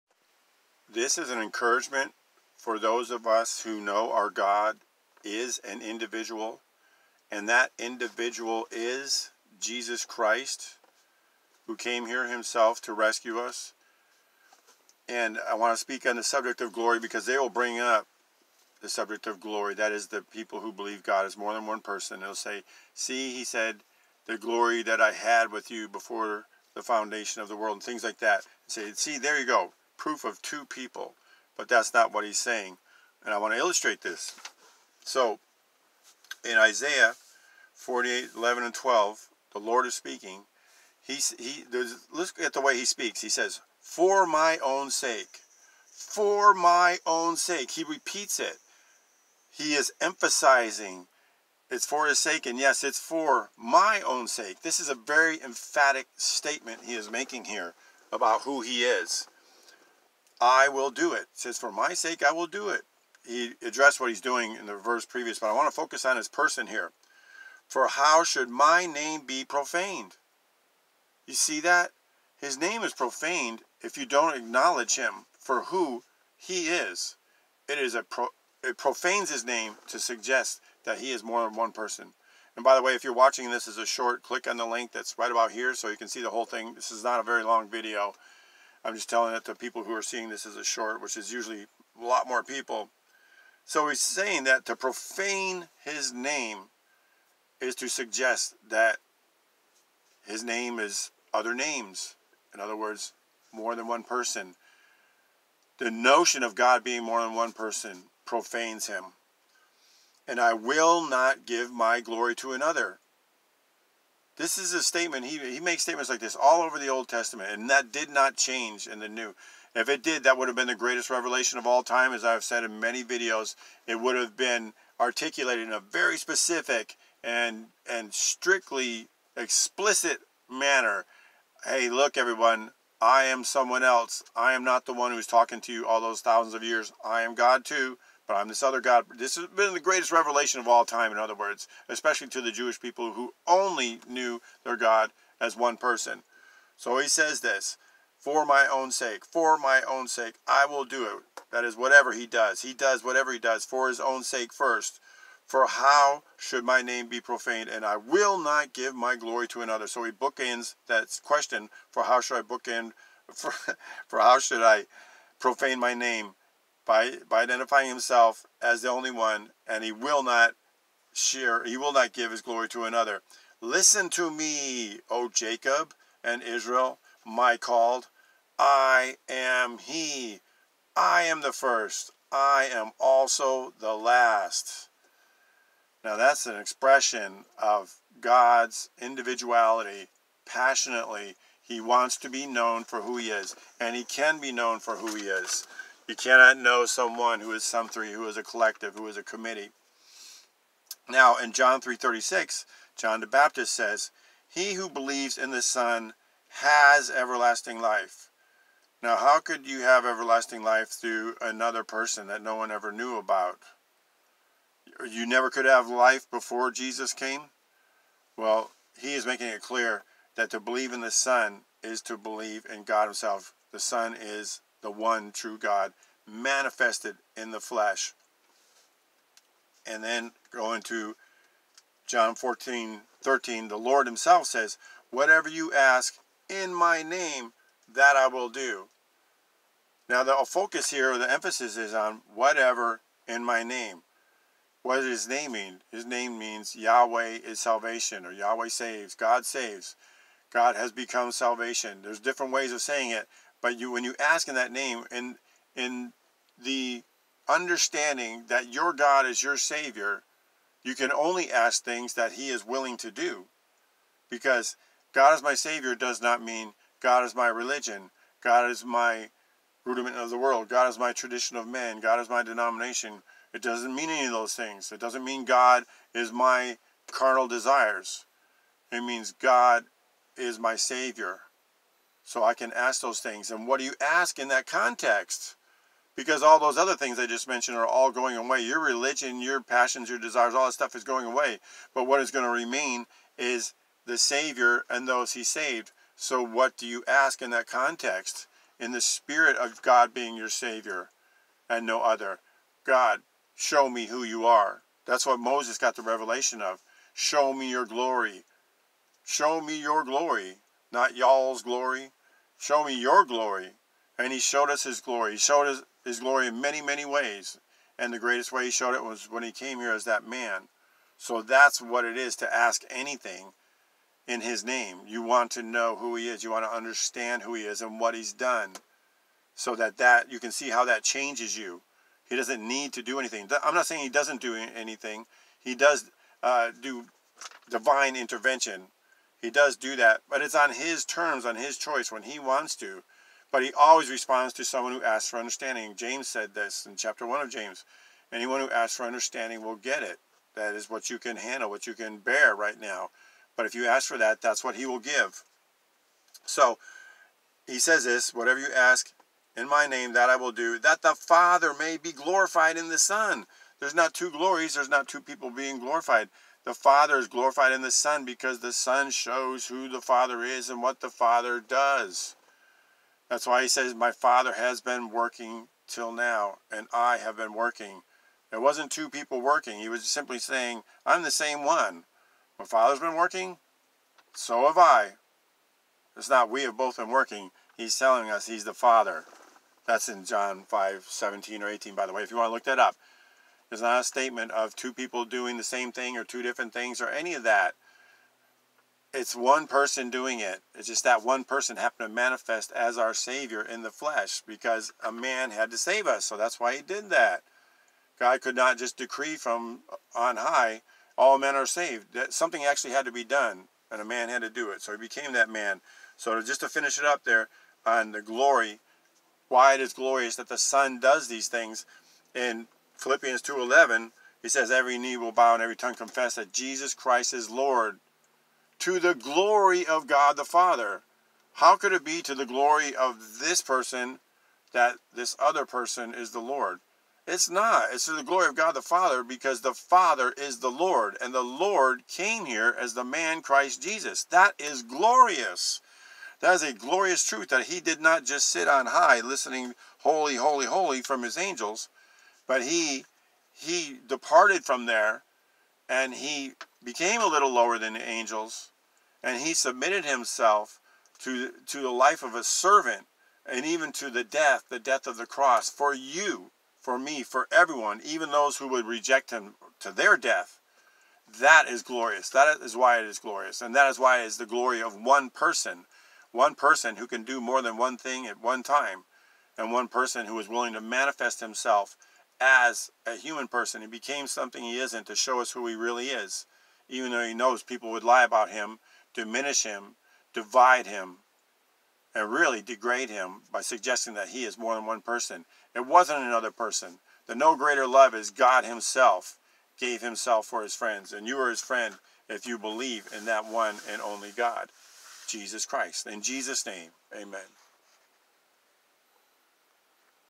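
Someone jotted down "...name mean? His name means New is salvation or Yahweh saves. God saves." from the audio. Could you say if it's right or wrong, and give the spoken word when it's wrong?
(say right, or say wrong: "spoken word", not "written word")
wrong: "Yahweh", not "New".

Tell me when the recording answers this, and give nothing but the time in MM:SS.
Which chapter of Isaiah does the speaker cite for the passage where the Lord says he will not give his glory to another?
00:37.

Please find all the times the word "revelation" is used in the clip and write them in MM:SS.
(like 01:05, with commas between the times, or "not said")
02:01, 02:20, 05:06.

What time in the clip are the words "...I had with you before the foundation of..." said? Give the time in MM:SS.
00:24.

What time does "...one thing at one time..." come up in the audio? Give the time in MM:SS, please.
07:57.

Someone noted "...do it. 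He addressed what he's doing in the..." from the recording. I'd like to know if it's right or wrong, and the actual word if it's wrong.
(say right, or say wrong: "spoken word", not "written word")
right.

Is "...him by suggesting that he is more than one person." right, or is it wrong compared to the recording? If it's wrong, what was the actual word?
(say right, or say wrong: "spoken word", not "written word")
right.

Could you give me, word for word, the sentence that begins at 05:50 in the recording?
That is what you can handle, what you can bear right now.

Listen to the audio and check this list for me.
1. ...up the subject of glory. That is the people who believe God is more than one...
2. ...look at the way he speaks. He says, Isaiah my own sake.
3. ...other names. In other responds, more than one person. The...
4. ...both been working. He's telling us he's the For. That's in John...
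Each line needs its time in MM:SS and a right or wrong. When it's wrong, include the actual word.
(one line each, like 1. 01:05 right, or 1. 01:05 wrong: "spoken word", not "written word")
1. 00:17 right
2. 00:42 wrong: "For", not "Isaiah"
3. 01:41 wrong: "words", not "responds"
4. 06:26 wrong: "Father", not "For".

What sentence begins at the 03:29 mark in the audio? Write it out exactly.
Now, how could you have everlasting life through another person that no one ever knew about?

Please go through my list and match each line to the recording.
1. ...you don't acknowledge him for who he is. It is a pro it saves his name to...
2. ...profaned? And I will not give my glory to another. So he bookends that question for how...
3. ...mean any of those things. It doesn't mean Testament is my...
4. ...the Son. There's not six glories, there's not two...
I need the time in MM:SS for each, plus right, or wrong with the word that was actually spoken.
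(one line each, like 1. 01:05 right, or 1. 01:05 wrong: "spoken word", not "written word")
1. 01:13 wrong: "profanes", not "saves"
2. 02:37 right
3. 04:33 wrong: "God", not "Testament"
4. 06:02 wrong: "two", not "six".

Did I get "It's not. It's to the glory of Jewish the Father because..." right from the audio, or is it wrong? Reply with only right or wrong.
wrong.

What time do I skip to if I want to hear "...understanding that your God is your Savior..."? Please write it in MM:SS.
04:17.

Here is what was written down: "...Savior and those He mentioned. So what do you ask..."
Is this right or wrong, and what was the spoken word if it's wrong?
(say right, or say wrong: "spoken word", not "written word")
wrong: "saved", not "mentioned".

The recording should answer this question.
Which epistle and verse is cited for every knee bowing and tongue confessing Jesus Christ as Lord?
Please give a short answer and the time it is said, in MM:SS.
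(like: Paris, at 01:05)
Philippians 2:11, at 07:03.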